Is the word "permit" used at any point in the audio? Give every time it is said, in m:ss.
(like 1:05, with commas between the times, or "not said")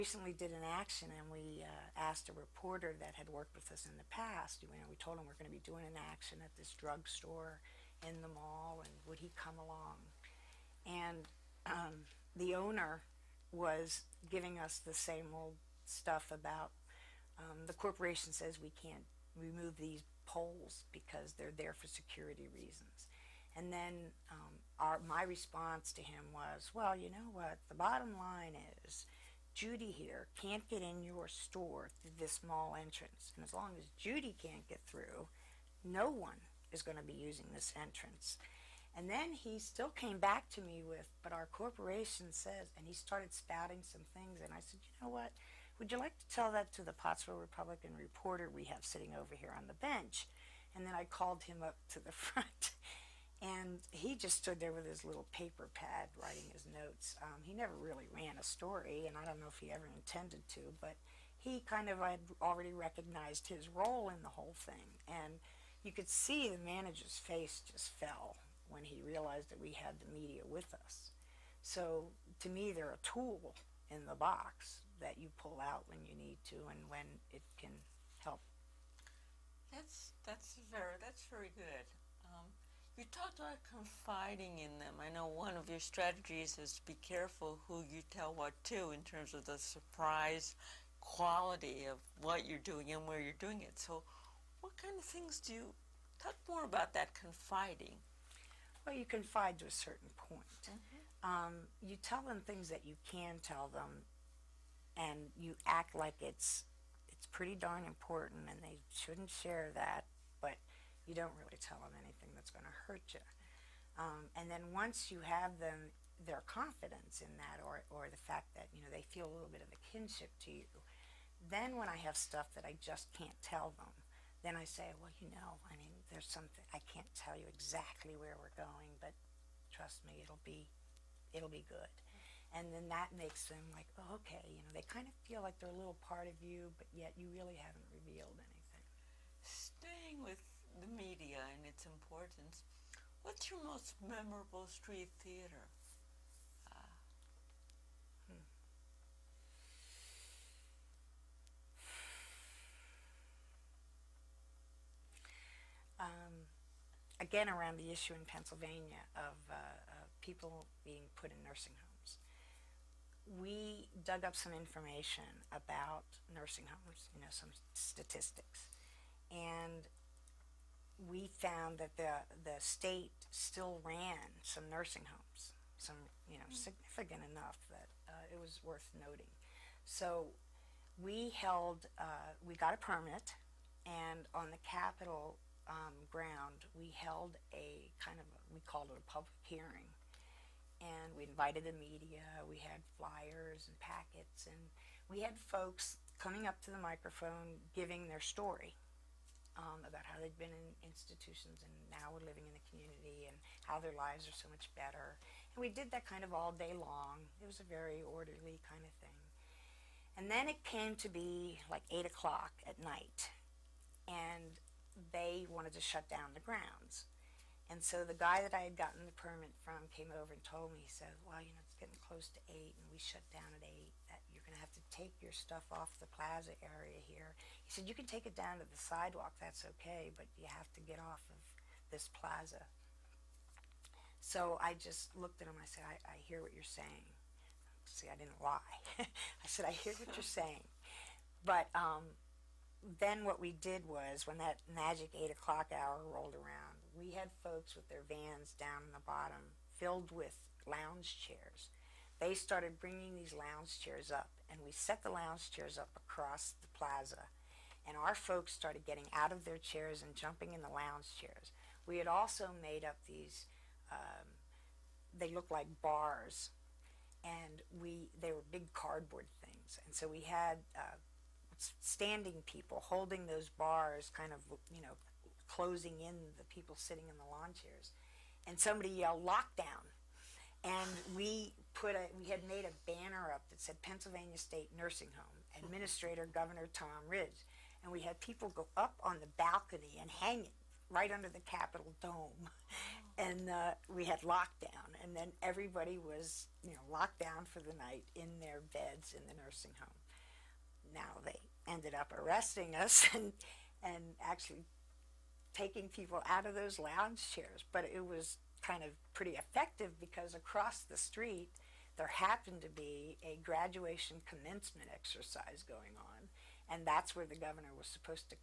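3:02, 3:39.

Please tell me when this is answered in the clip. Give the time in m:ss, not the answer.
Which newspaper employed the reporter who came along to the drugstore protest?
0:46.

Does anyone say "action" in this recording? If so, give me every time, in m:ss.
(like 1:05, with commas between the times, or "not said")
0:00, 0:06.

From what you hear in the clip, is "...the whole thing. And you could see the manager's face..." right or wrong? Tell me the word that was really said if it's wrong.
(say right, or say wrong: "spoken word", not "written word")
right.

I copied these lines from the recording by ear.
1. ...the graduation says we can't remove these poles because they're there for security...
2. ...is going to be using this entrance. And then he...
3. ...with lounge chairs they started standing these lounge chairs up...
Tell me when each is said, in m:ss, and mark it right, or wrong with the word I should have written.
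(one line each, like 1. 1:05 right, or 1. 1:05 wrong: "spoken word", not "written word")
1. 0:17 wrong: "corporation", not "graduation"
2. 0:36 right
3. 4:10 wrong: "bringing", not "standing".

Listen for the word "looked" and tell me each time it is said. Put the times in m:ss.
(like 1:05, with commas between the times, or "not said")
3:55, 4:25.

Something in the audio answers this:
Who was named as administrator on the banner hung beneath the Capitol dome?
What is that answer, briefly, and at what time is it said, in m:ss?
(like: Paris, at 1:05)
Governor Tom Ridge, at 4:46.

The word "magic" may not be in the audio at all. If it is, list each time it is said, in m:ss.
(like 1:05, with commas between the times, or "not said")
4:04.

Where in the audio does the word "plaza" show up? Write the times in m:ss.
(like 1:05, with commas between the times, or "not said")
3:46, 3:52, 4:16.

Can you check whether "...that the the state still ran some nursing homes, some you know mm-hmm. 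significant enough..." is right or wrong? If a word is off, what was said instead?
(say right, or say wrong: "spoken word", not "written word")
right.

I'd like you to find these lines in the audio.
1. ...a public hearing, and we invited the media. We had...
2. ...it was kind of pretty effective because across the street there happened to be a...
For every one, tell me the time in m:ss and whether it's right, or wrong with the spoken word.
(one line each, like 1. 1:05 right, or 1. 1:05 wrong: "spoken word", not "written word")
1. 3:08 right
2. 5:07 right.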